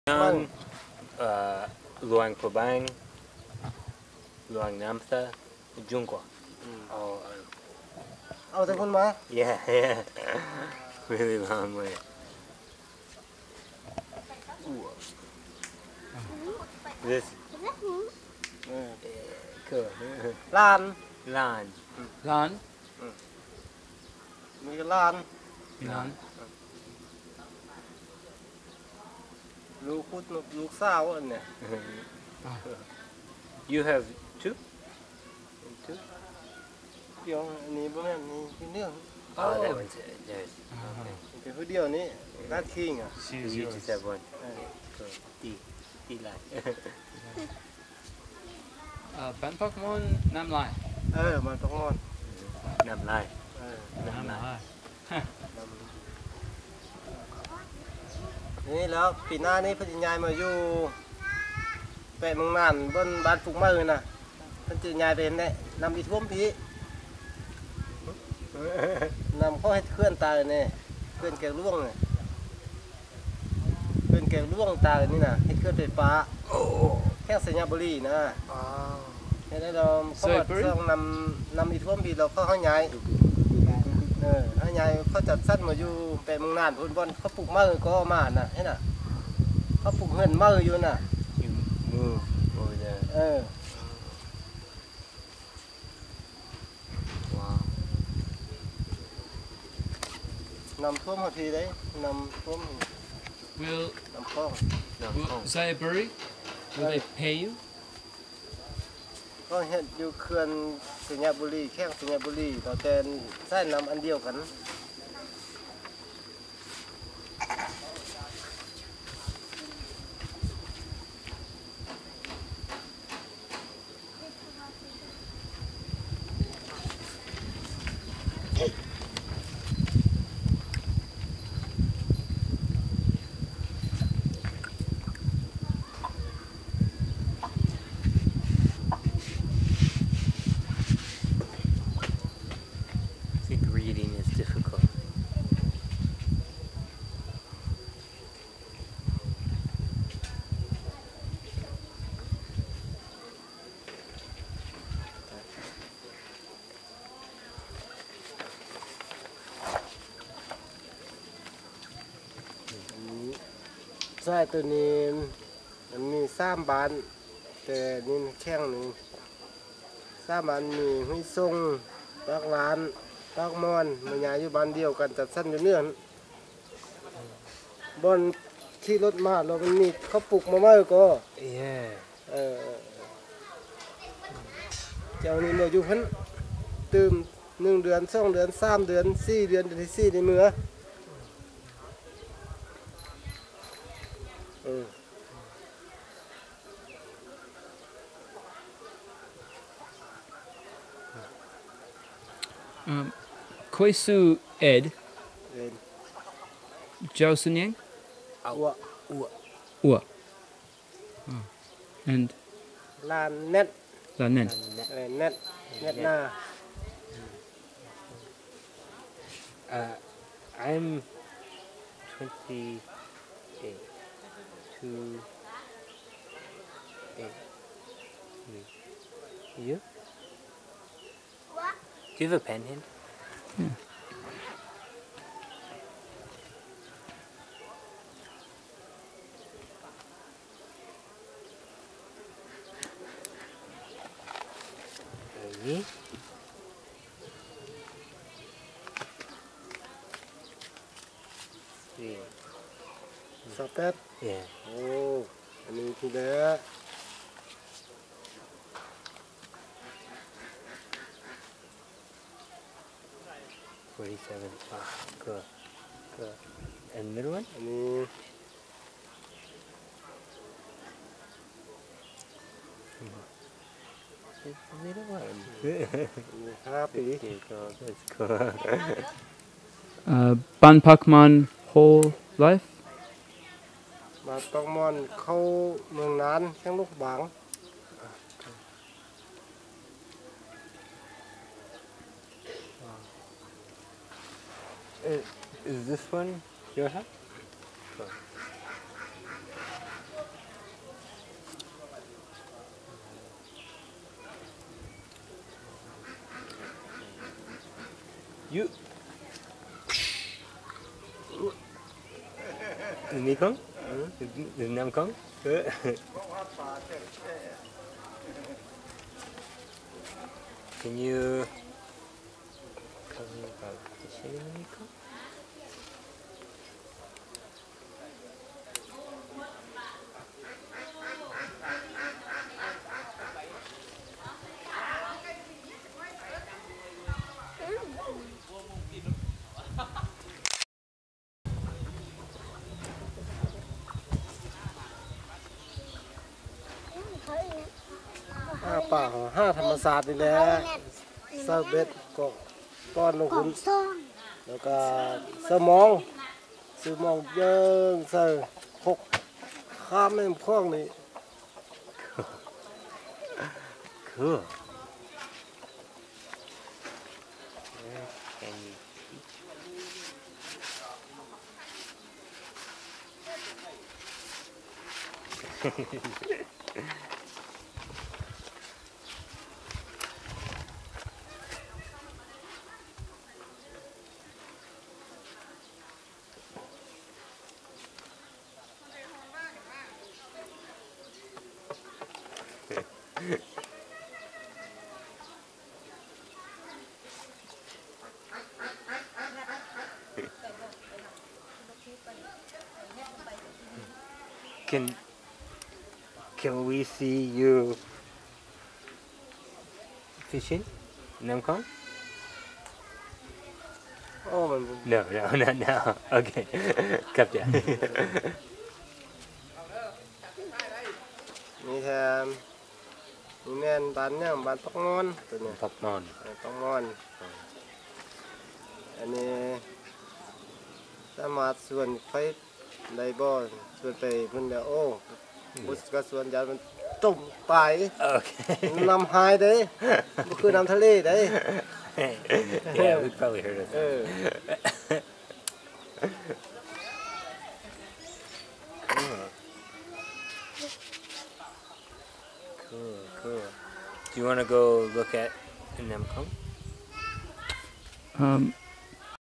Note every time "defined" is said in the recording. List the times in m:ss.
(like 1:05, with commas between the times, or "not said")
not said.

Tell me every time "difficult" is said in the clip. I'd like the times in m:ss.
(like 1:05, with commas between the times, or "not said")
2:24.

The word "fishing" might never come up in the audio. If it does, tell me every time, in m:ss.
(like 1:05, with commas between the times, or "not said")
6:50.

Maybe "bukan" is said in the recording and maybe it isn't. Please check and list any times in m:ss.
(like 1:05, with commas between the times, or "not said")
0:37.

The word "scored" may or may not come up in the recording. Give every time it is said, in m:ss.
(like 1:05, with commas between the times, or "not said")
not said.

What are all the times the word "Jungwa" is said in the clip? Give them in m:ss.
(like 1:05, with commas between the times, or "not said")
0:05.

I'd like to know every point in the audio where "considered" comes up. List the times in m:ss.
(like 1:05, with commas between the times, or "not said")
not said.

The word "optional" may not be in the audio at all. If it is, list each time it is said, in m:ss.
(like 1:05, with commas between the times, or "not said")
not said.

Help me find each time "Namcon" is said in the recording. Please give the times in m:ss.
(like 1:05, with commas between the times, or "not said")
6:51, 7:35.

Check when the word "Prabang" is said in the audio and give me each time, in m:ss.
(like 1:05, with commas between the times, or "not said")
0:02.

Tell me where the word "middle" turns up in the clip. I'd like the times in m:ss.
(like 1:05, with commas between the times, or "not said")
4:27, 4:34.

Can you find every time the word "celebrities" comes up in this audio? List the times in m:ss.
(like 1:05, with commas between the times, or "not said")
not said.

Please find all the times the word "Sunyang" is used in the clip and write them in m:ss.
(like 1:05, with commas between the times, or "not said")
3:27.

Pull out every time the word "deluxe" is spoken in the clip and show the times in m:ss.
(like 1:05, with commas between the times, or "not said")
not said.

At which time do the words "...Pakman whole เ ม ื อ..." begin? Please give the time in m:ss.
4:44.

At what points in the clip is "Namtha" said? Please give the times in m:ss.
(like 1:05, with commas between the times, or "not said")
0:04.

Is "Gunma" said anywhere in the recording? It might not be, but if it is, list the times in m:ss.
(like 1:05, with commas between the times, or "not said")
0:08.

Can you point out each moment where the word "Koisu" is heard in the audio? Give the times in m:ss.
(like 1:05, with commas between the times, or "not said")
3:23.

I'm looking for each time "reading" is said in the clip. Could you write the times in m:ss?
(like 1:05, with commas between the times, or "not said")
2:23.